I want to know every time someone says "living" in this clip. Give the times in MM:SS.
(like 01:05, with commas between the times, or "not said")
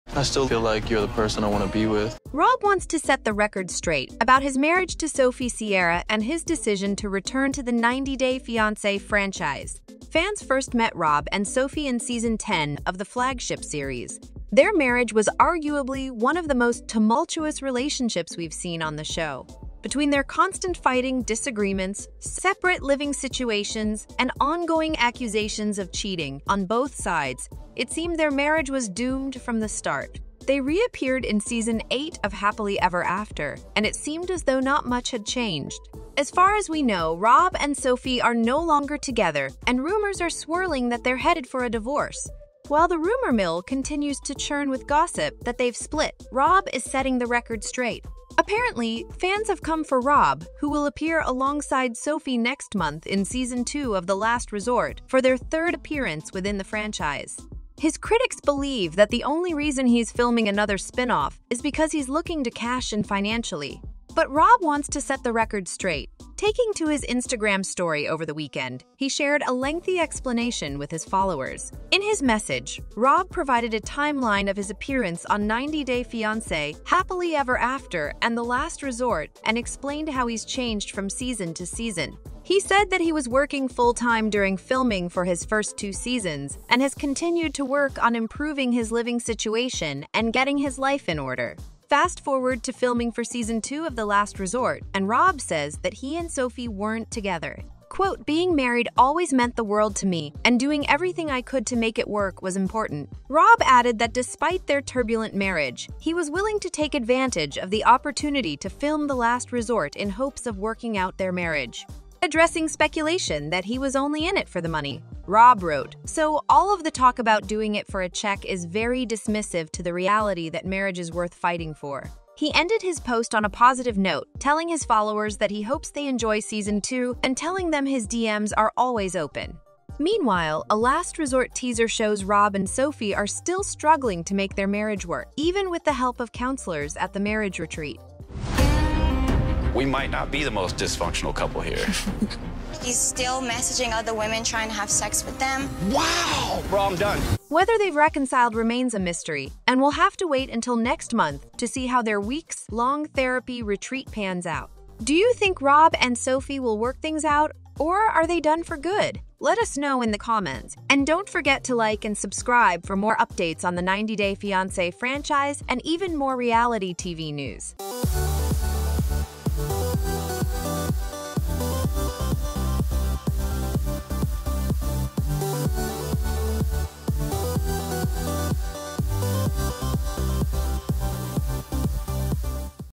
00:22, 01:28.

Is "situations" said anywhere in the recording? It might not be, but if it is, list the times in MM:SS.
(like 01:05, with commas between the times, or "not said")
00:23, 01:29.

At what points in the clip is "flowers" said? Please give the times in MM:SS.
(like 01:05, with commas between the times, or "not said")
not said.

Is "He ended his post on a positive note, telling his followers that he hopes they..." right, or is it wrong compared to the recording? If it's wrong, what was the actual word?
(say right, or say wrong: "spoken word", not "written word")
right.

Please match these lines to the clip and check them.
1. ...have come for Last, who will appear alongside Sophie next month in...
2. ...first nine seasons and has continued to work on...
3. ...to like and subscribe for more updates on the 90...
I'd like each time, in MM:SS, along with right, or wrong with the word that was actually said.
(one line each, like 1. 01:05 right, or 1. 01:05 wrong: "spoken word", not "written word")
1. 00:49 wrong: "Rob", not "Last"
2. 01:25 wrong: "two", not "nine"
3. 02:41 right.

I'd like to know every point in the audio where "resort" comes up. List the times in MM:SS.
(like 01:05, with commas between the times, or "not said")
00:54, 01:18, 01:34, 01:49, 02:11.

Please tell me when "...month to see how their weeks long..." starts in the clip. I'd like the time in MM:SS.
02:31.